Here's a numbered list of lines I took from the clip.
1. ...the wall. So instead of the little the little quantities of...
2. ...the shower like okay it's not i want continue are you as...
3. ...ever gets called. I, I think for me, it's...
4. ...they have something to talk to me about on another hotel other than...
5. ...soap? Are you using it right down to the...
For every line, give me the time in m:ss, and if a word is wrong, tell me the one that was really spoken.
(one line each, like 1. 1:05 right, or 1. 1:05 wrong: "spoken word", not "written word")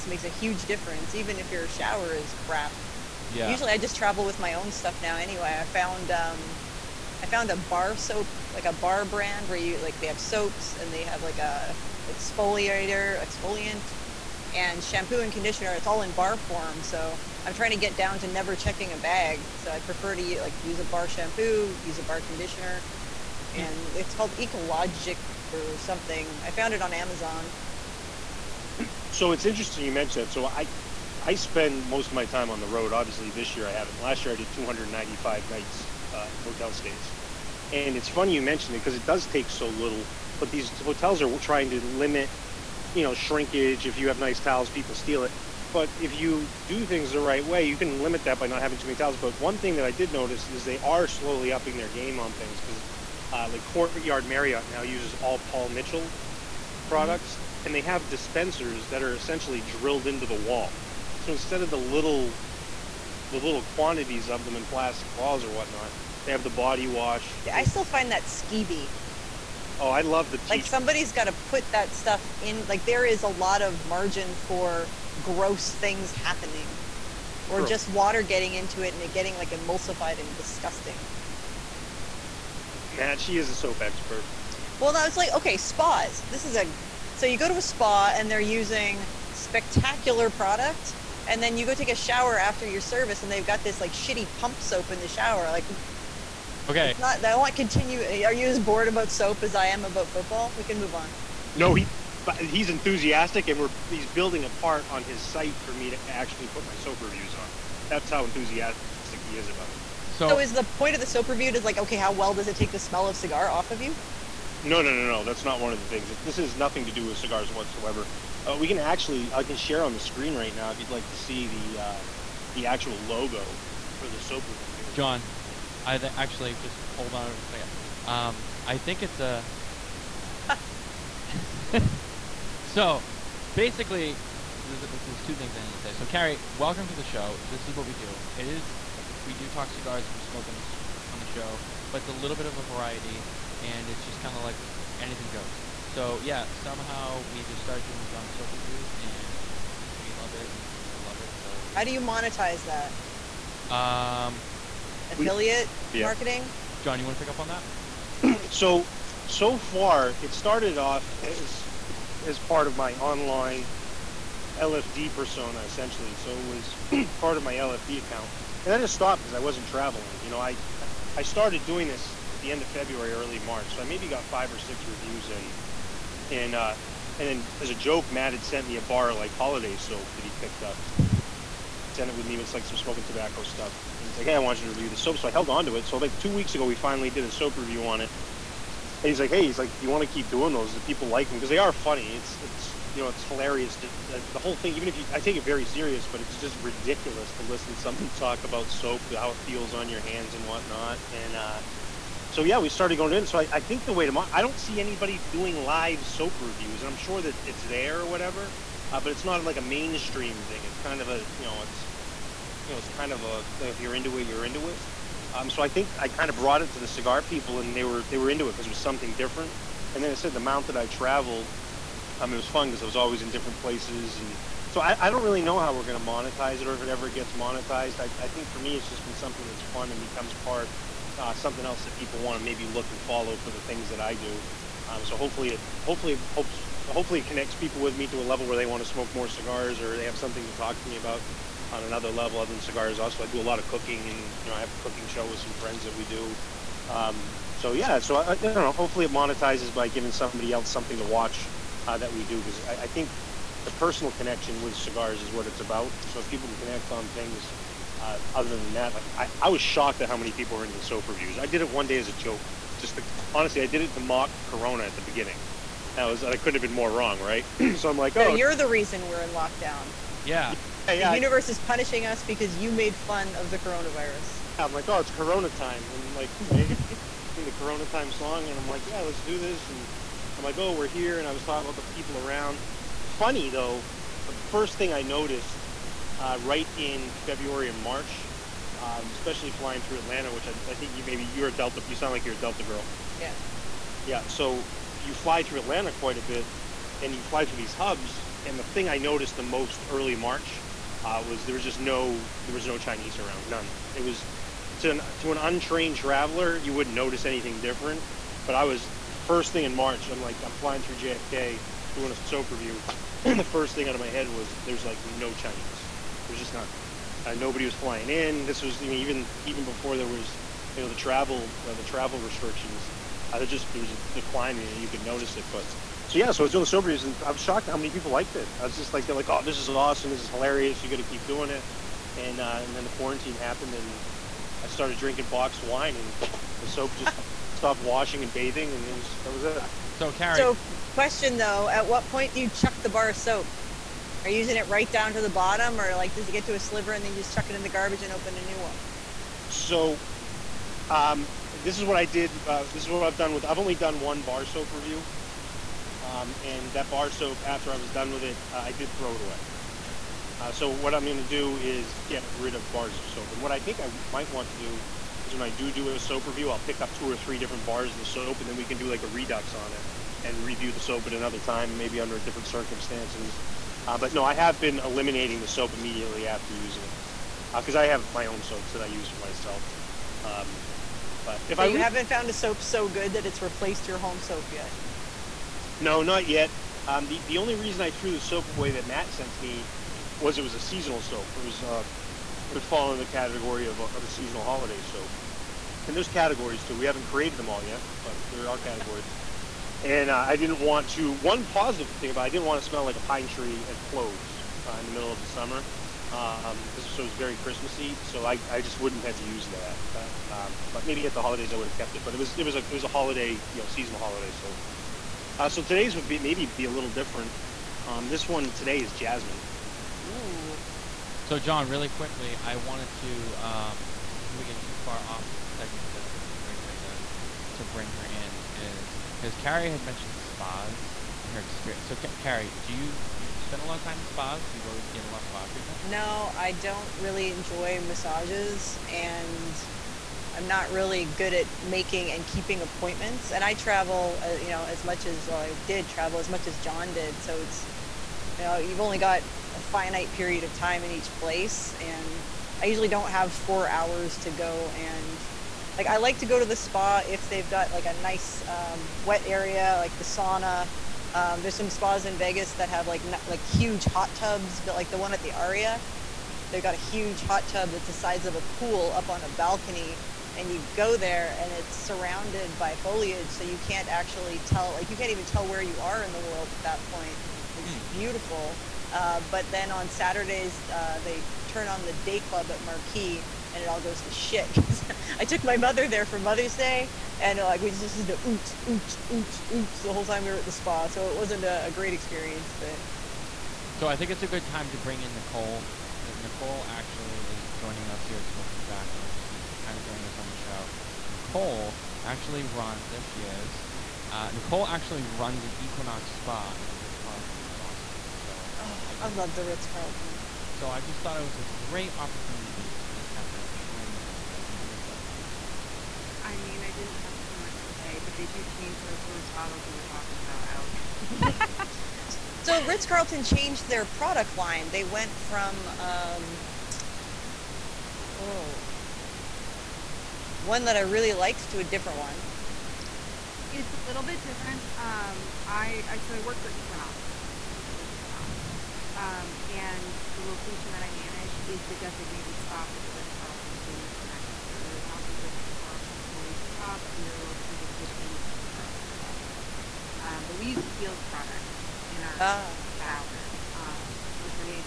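1. 1:00 right
2. 1:34 right
3. 3:46 wrong: "monetized", not "called"
4. 3:59 wrong: "level", not "hotel"
5. 5:43 right.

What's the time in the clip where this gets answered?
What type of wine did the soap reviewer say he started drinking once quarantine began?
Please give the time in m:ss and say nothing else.
5:35.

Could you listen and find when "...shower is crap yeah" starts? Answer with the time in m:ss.
0:01.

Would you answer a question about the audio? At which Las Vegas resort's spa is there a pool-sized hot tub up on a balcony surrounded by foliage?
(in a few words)
the Aria.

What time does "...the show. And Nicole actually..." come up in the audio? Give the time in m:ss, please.
8:20.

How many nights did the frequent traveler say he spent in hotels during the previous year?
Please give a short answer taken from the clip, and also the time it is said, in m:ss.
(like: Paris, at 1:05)
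295, at 0:34.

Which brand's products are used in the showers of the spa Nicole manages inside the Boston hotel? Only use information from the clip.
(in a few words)
Kiehl's.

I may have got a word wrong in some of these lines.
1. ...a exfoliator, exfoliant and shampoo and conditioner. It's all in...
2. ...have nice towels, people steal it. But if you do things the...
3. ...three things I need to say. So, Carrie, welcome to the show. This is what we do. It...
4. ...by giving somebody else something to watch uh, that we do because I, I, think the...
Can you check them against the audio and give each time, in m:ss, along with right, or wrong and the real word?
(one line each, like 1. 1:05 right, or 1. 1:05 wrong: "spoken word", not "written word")
1. 0:11 right
2. 0:44 right
3. 2:15 wrong: "two", not "three"
4. 4:09 right.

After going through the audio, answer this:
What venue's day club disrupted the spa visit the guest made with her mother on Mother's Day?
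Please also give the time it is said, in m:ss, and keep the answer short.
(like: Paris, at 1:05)
Marquee, at 8:02.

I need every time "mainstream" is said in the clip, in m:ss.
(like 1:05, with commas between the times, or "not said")
3:29.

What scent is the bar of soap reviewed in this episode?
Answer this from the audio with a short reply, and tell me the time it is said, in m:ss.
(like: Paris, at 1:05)
Jasmine, at 6:58.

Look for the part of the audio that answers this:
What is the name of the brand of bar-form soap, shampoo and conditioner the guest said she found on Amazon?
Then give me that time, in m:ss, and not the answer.
0:24.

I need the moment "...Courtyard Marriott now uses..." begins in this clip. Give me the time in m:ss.
0:53.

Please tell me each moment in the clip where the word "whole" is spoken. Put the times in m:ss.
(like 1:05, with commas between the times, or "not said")
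3:14, 8:09.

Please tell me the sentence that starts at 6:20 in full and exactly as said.
Um, but if so I you haven't found a soap so good that it's replaced your home soap yet.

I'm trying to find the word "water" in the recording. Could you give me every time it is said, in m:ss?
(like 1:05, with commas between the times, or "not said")
1:17.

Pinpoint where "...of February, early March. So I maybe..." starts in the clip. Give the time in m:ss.
2:52.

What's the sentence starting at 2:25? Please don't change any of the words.
So yeah, somehow we just started doing John Soap reviews, and we love it, and people love it.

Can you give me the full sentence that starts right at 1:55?
That's not one of the things.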